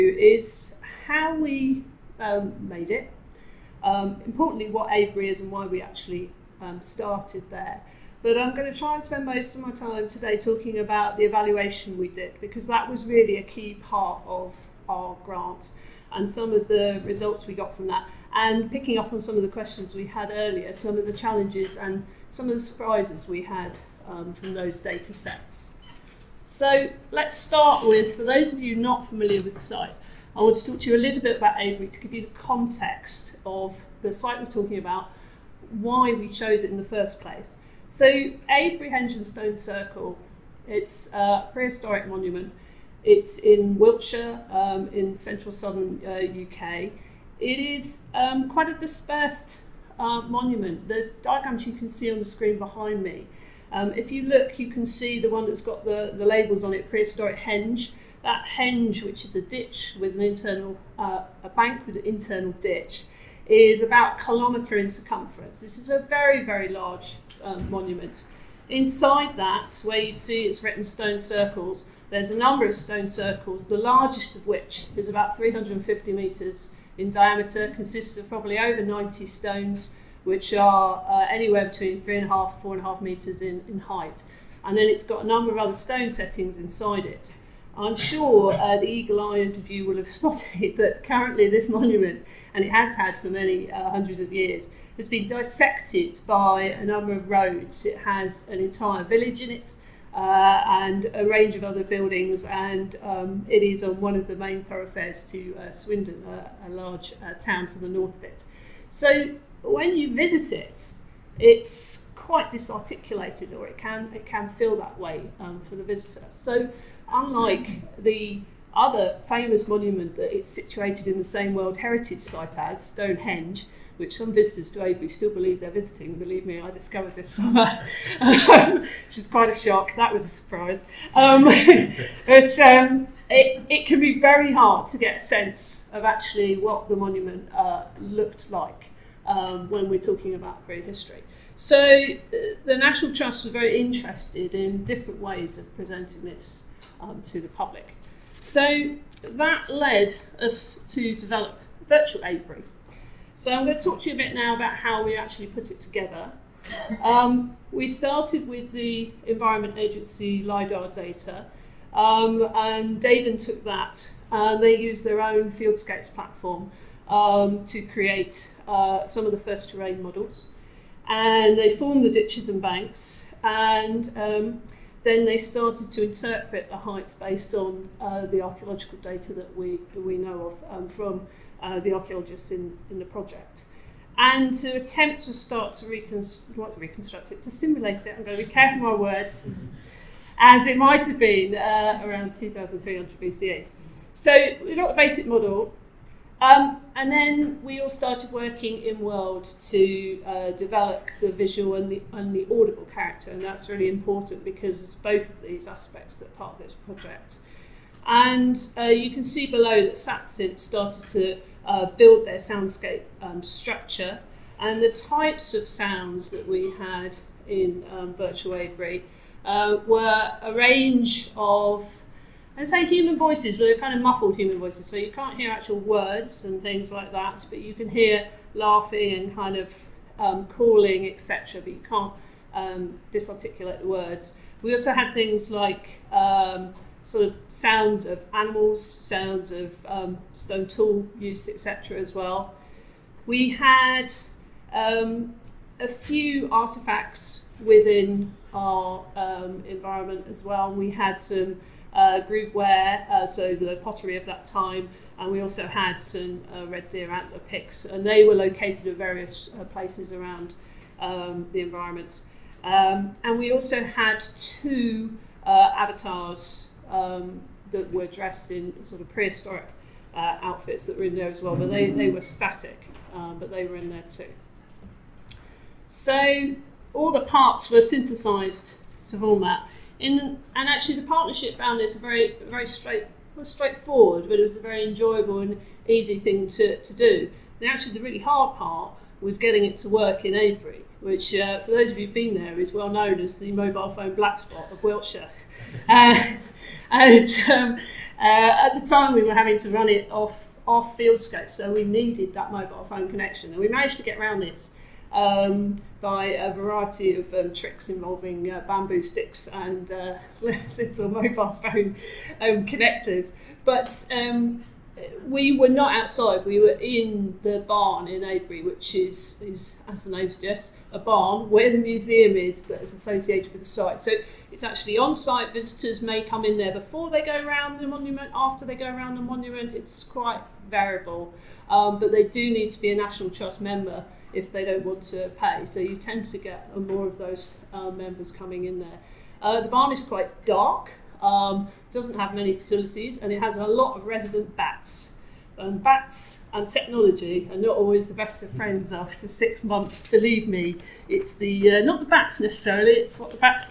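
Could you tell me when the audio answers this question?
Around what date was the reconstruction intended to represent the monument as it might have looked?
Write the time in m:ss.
3:12.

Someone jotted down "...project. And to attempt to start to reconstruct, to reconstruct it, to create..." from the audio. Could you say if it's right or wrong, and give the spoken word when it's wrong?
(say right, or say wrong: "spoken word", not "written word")
wrong: "simulate", not "create".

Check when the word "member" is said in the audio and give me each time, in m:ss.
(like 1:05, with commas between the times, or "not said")
5:33, 5:37.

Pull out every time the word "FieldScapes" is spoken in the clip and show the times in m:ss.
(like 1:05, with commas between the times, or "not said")
2:45, 5:00.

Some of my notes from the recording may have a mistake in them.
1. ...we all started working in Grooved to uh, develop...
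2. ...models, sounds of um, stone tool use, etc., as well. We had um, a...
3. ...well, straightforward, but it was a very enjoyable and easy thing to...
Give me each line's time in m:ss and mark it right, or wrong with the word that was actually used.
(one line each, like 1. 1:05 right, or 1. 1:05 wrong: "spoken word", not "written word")
1. 3:17 wrong: "World", not "Grooved"
2. 3:58 wrong: "animals", not "models"
3. 4:43 right.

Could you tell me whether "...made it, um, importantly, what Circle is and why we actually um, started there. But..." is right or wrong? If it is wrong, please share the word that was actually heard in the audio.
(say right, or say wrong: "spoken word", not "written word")
wrong: "Avebury", not "Circle".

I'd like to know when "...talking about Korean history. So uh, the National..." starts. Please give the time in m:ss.
2:19.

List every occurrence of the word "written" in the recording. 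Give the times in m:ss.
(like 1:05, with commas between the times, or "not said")
1:10.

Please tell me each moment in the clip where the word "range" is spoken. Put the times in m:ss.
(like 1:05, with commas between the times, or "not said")
1:41, 3:40.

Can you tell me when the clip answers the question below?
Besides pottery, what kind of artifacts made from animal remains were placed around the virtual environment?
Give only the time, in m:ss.
4:16.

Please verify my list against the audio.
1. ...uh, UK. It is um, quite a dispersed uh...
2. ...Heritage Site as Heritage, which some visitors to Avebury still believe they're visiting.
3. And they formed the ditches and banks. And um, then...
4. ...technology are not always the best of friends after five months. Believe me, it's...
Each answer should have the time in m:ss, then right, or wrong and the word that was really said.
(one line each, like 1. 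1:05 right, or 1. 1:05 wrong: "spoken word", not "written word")
1. 0:46 right
2. 2:01 wrong: "Stonehenge", not "Heritage"
3. 2:51 right
4. 5:46 wrong: "six", not "five".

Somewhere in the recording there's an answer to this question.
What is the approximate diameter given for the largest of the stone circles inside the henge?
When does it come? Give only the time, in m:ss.
1:15.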